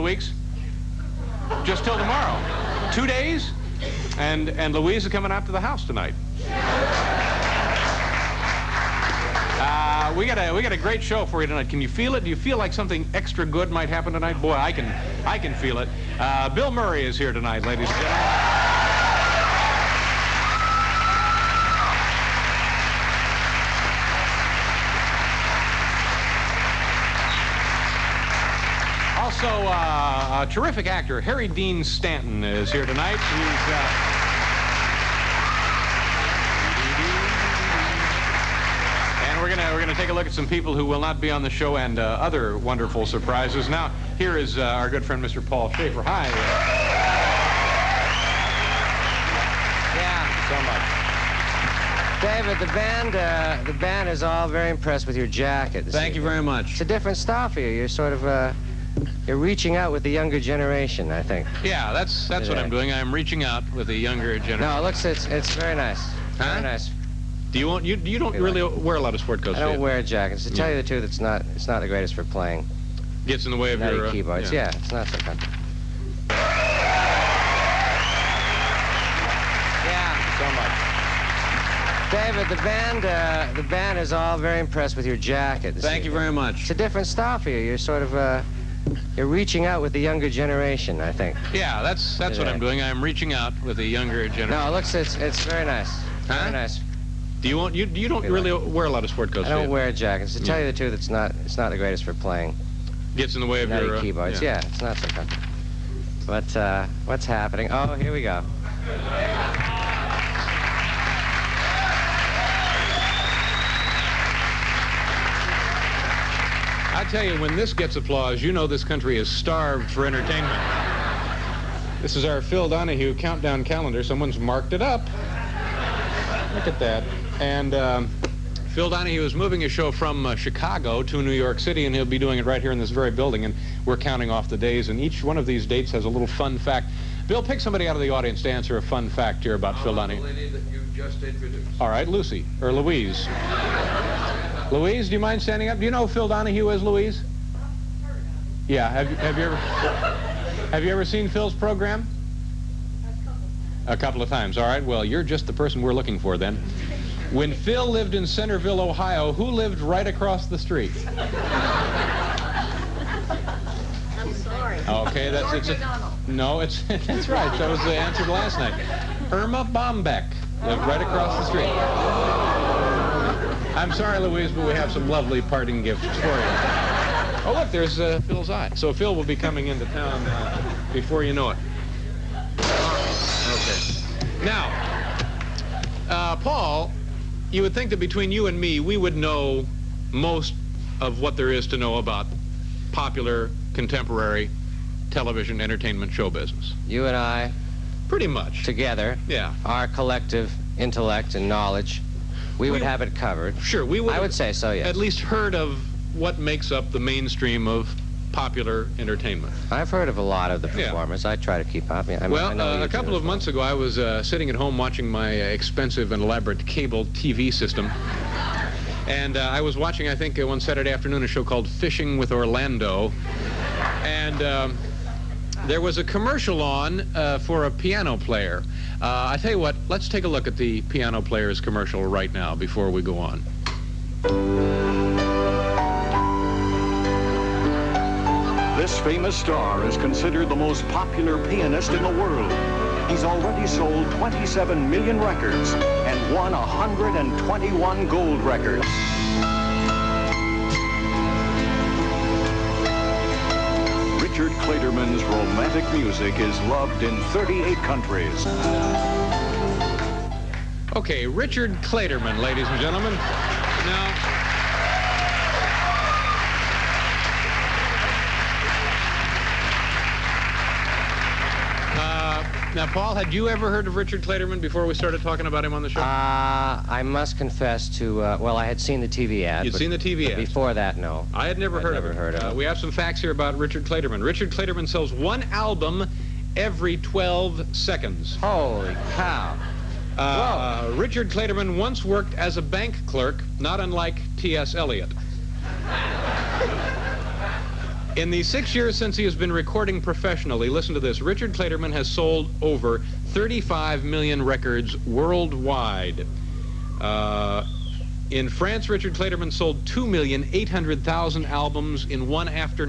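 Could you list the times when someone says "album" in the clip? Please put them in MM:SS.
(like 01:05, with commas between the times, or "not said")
04:45, 05:11.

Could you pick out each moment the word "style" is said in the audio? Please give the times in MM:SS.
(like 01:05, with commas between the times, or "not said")
00:57, 01:27.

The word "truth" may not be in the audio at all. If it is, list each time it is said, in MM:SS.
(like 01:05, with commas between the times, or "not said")
01:10, 01:40.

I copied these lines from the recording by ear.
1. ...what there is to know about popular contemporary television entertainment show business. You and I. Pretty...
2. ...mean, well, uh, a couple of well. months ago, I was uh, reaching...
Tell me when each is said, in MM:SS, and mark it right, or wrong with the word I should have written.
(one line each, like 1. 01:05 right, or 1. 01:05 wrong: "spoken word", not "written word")
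1. 03:11 right
2. 03:32 wrong: "sitting", not "reaching".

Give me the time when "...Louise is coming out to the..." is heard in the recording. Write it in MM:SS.
00:04.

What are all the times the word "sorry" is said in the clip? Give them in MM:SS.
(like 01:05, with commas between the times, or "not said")
02:44, 02:53.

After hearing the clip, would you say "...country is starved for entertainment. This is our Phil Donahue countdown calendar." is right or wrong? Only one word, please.
right.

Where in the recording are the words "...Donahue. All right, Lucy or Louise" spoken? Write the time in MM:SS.
02:19.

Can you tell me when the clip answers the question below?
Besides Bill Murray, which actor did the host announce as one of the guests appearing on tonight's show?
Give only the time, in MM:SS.
00:31.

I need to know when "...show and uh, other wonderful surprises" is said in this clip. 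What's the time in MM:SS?
00:41.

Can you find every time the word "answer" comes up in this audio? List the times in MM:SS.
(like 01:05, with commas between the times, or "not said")
02:18, 02:47.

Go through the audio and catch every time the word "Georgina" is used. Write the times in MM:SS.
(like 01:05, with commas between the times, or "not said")
not said.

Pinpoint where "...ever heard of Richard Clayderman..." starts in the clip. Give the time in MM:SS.
04:33.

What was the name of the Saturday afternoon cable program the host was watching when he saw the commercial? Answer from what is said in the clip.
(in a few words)
Fishing with Orlando.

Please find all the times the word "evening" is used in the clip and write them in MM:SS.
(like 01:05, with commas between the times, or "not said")
00:56, 01:25.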